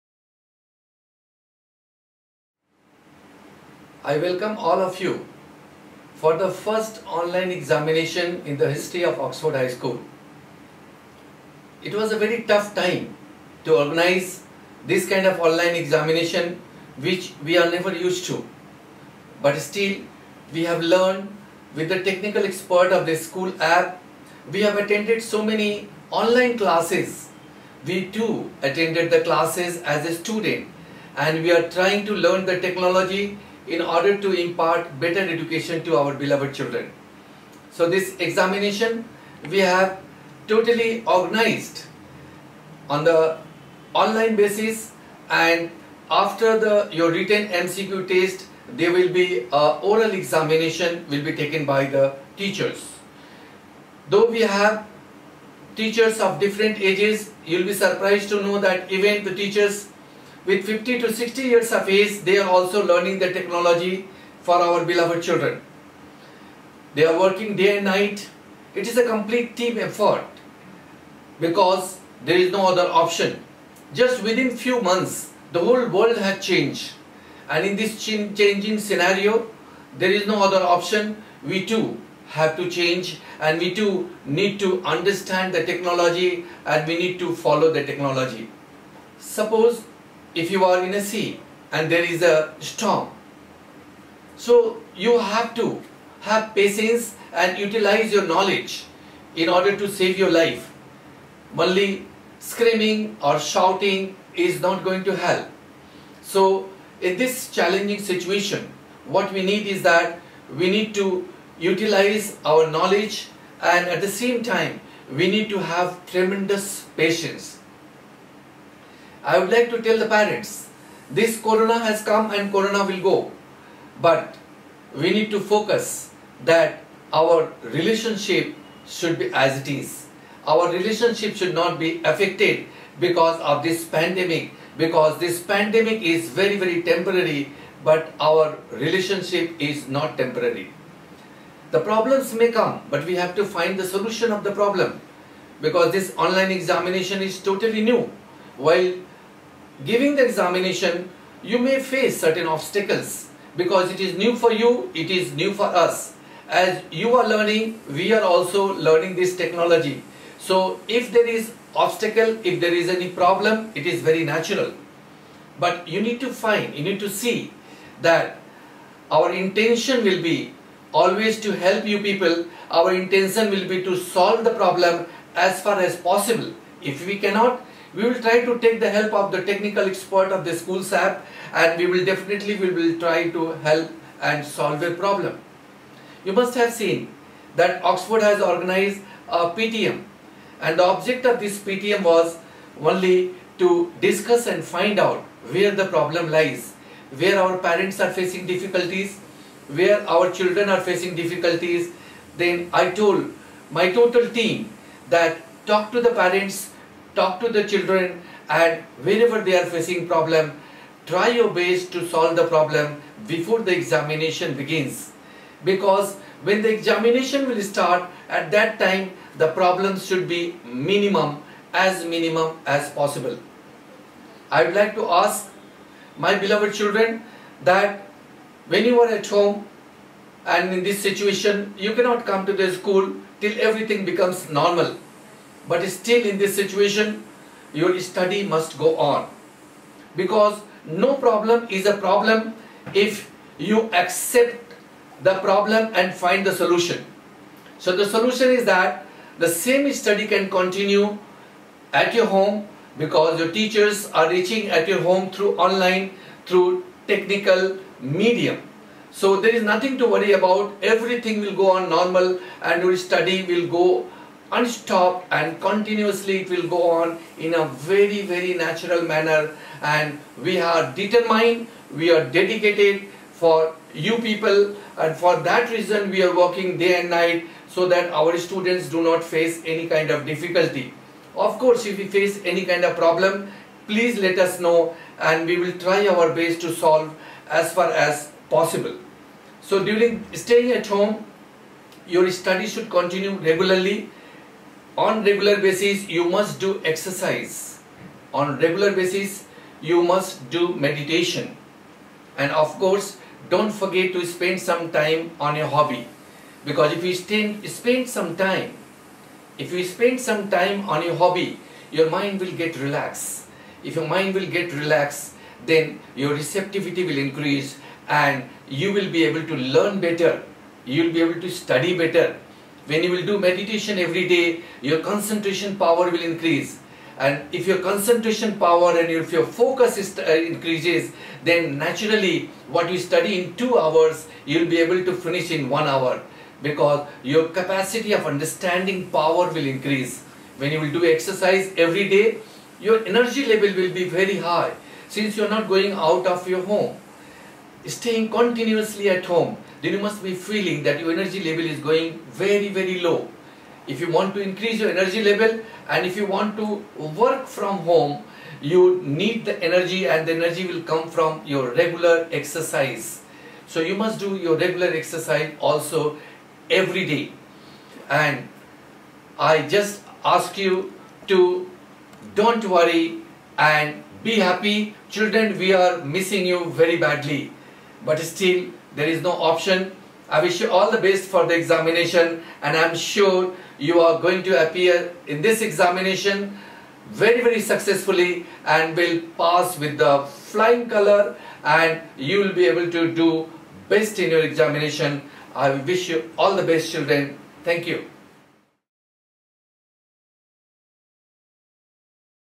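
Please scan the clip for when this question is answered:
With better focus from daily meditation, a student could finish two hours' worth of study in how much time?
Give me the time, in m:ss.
5:35.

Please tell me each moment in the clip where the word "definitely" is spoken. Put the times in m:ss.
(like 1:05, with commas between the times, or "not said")
3:02.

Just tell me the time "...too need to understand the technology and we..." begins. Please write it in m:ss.
1:23.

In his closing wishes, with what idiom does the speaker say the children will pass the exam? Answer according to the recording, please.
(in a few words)
flying color.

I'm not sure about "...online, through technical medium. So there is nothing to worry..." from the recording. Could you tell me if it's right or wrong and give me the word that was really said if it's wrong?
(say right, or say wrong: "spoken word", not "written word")
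right.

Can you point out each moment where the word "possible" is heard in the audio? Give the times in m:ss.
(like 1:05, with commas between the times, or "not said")
2:55, 3:42, 4:48.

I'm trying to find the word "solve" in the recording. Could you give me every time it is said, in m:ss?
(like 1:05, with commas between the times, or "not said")
2:53, 3:04, 3:32, 4:46.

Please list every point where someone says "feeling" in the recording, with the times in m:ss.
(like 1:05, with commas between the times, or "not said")
5:50.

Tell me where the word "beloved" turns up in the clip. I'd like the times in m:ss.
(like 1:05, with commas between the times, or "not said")
0:36, 1:04, 3:46.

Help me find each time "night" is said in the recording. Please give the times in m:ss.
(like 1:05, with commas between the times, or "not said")
1:07, 4:37.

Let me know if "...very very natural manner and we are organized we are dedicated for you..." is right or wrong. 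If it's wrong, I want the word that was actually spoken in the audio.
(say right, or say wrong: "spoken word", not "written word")
wrong: "determined", not "organized".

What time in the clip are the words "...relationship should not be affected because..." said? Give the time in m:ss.
2:10.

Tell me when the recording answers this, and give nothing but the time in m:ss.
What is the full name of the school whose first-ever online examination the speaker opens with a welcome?
0:09.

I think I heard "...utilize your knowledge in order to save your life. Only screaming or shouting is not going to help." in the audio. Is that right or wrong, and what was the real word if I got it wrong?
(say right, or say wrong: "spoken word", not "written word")
right.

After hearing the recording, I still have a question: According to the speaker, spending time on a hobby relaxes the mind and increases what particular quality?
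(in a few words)
receptivity.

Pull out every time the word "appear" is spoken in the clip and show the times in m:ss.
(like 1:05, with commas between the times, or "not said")
6:24.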